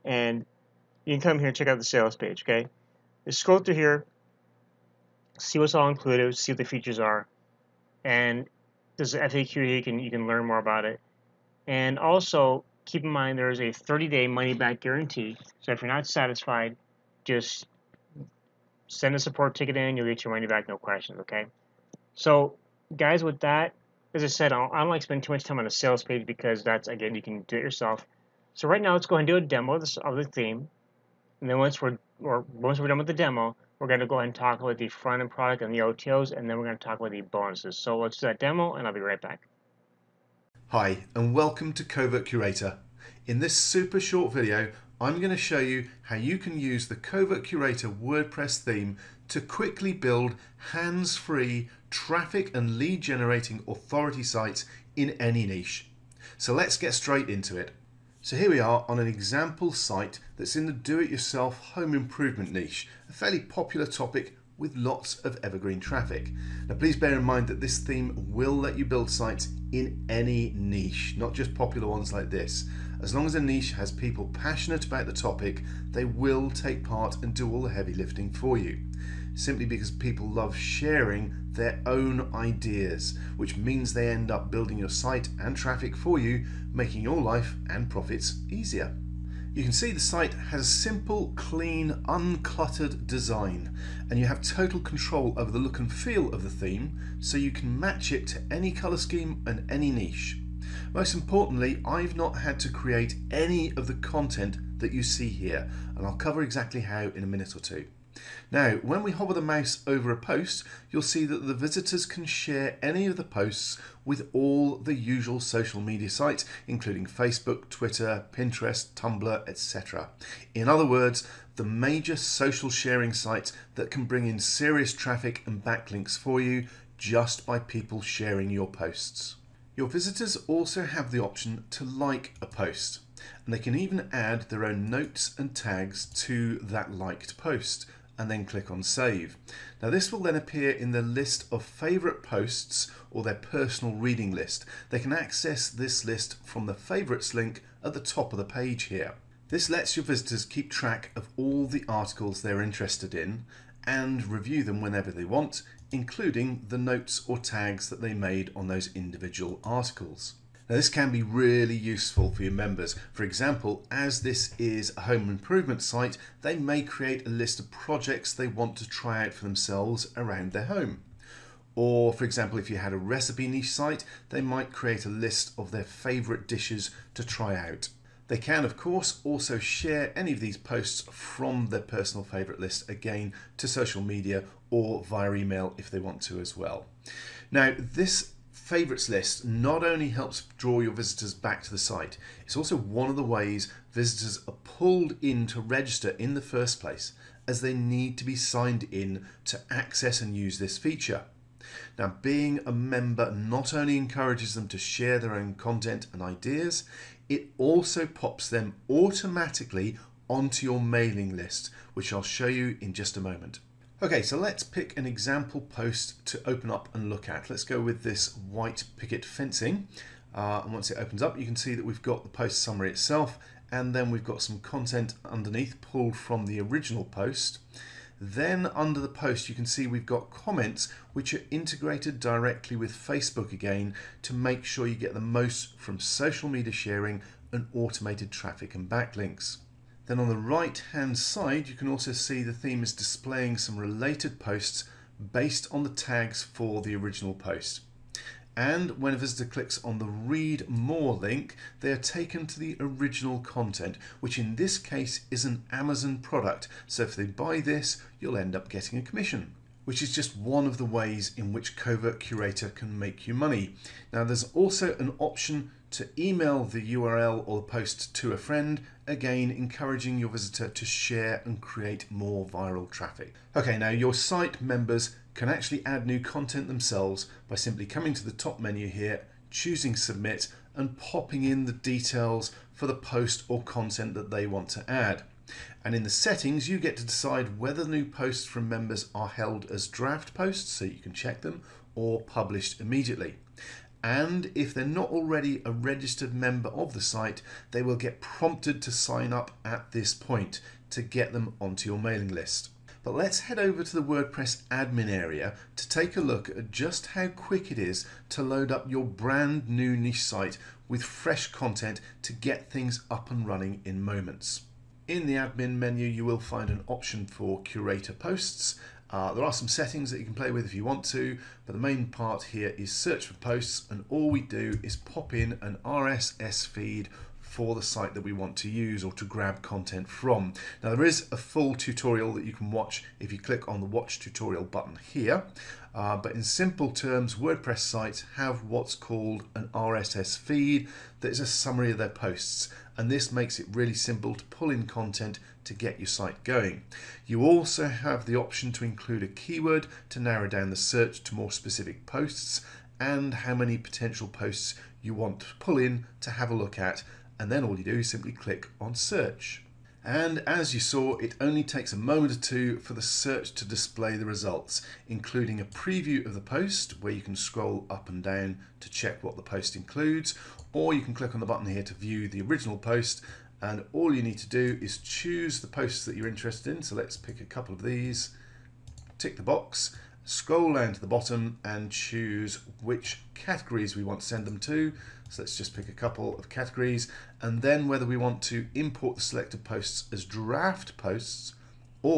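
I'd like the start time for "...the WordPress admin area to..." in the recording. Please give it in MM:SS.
05:03.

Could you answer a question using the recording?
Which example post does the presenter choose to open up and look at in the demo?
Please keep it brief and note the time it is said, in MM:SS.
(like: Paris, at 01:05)
White picket fencing, at 03:38.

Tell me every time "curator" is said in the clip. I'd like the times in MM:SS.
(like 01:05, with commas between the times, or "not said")
00:42, 00:47, 04:22, 05:17.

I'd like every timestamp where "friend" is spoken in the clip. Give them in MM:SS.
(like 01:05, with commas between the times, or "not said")
04:28.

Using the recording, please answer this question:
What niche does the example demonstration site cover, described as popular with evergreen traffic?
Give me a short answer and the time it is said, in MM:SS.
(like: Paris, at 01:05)
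Do-it-yourself home improvement, at 01:00.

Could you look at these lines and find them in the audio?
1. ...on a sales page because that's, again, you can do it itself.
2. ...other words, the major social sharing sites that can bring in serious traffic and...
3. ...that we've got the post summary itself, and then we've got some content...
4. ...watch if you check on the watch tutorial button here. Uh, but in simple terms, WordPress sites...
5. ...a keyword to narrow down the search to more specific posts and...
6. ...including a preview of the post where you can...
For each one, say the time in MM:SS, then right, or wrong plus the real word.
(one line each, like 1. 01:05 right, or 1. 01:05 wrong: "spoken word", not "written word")
1. 00:25 wrong: "yourself", not "itself"
2. 02:00 right
3. 03:41 right
4. 05:32 wrong: "click", not "check"
5. 05:49 right
6. 06:05 right.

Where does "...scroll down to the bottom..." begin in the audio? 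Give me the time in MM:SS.
06:20.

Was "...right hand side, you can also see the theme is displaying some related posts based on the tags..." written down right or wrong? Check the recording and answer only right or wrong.
right.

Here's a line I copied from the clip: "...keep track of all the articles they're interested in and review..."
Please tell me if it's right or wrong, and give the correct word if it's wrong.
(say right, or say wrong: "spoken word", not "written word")
right.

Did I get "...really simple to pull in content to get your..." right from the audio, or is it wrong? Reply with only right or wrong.
right.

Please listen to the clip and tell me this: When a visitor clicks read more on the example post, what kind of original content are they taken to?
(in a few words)
An Amazon product.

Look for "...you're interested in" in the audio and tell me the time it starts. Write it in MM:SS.
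06:16.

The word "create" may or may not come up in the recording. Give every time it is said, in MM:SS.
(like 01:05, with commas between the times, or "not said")
01:42, 02:46, 02:54, 04:31.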